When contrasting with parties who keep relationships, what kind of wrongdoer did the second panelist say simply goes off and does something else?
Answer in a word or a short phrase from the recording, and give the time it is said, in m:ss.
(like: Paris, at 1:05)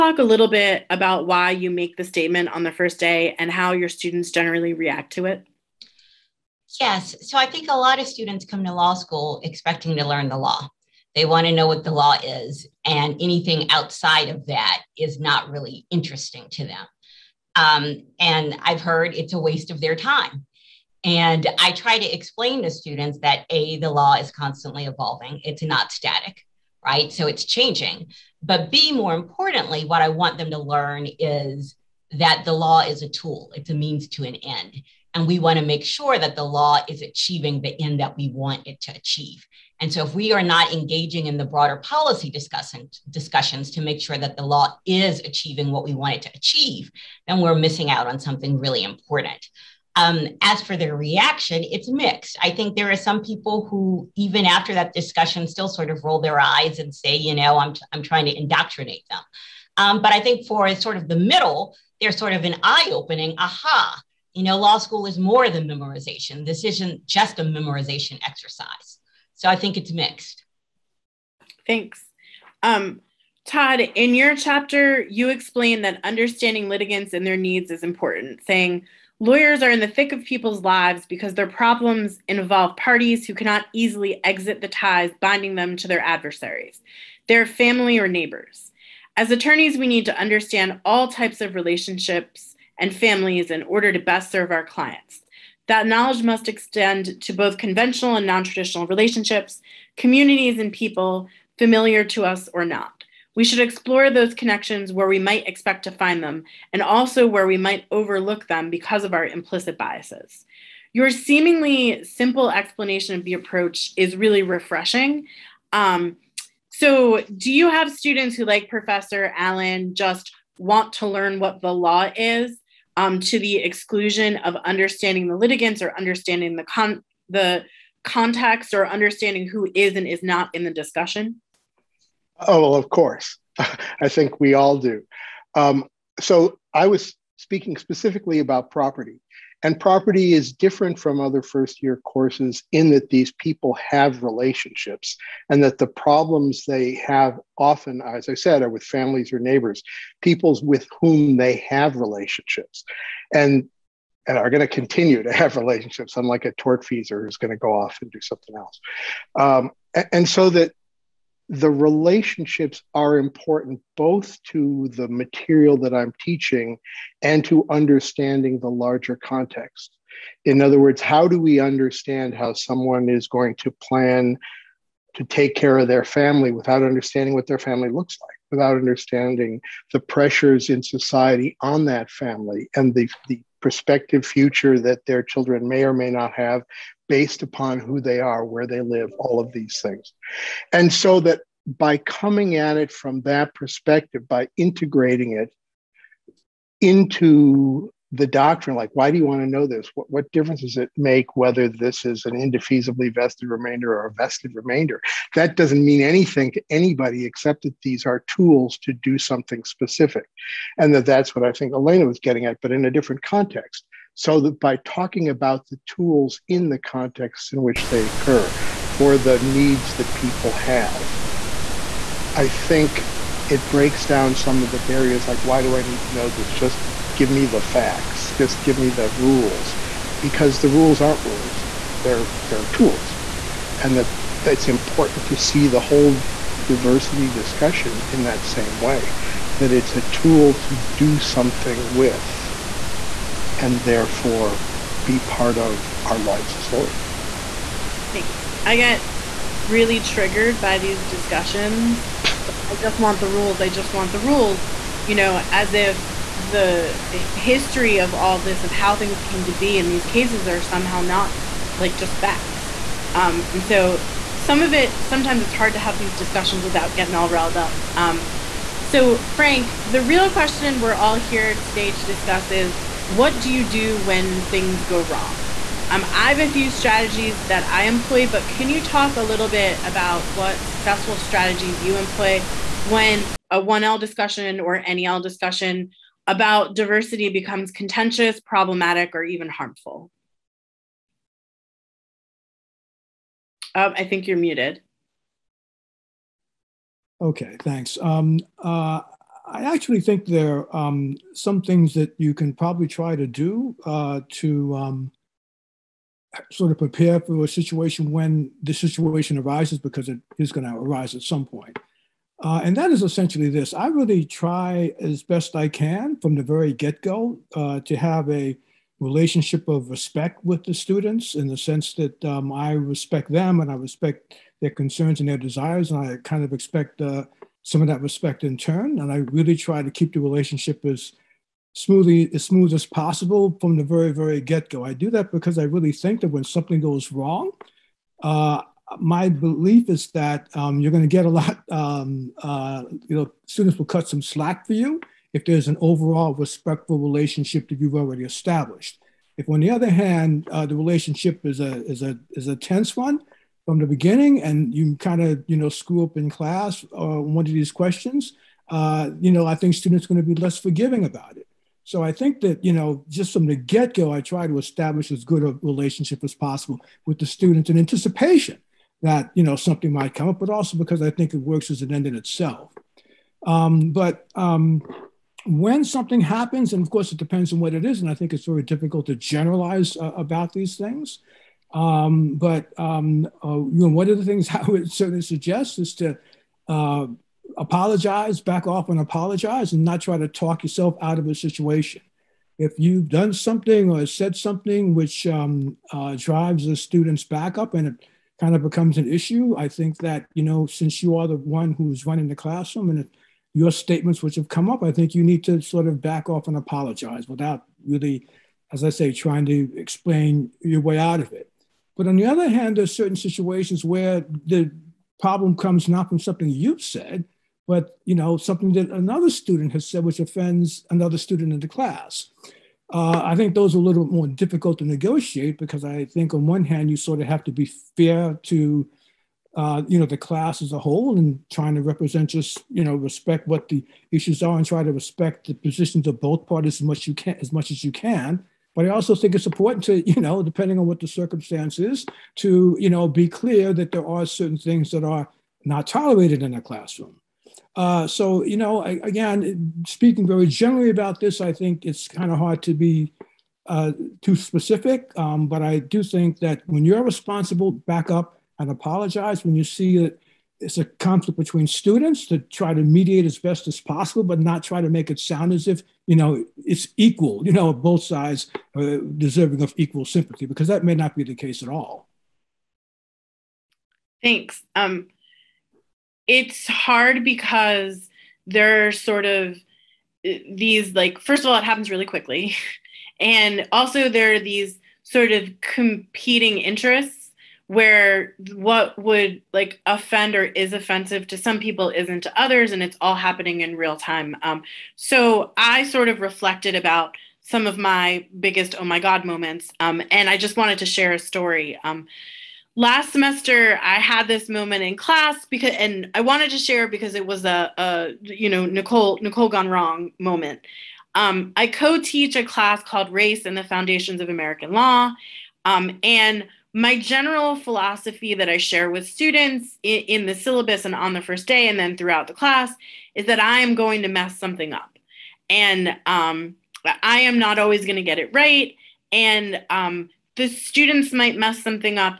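a tortfeasor, at 2:36.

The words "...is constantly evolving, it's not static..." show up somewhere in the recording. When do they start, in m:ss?
0:24.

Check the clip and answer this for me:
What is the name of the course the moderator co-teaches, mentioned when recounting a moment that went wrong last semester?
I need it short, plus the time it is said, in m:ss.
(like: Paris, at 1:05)
Race and the Foundations of American Law, at 8:33.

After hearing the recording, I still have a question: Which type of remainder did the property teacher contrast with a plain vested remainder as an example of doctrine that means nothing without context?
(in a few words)
indefeasibly vested remainder.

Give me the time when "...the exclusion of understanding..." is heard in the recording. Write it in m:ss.
2:03.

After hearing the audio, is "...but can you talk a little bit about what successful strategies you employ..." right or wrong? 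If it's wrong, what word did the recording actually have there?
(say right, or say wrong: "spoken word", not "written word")
right.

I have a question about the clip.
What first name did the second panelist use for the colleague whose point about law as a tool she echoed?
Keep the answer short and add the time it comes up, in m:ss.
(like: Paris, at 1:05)
Alena, at 3:31.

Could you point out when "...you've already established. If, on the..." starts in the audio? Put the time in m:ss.
5:47.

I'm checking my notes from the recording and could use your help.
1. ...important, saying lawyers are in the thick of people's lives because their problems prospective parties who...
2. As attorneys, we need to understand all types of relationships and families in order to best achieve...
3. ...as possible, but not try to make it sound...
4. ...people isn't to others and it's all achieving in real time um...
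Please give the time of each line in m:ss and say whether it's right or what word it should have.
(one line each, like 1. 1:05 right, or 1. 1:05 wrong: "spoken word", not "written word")
1. 1:17 wrong: "involve", not "prospective"
2. 1:29 wrong: "serve", not "achieve"
3. 7:43 right
4. 8:11 wrong: "happening", not "achieving".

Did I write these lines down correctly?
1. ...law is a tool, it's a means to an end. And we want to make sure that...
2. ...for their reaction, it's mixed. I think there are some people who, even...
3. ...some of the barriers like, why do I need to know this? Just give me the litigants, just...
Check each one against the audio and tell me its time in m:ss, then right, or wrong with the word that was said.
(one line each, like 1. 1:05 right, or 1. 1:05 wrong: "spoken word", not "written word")
1. 0:32 right
2. 0:50 right
3. 3:44 wrong: "facts", not "litigants".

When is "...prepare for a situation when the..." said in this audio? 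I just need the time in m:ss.
5:06.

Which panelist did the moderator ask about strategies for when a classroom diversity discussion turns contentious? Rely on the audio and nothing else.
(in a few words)
Frank.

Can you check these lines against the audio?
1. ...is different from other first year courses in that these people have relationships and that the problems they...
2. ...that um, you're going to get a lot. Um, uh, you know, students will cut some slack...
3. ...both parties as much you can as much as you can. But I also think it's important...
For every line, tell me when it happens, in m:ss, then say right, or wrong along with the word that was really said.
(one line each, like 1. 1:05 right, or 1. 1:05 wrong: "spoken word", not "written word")
1. 2:20 right
2. 5:40 right
3. 7:16 right.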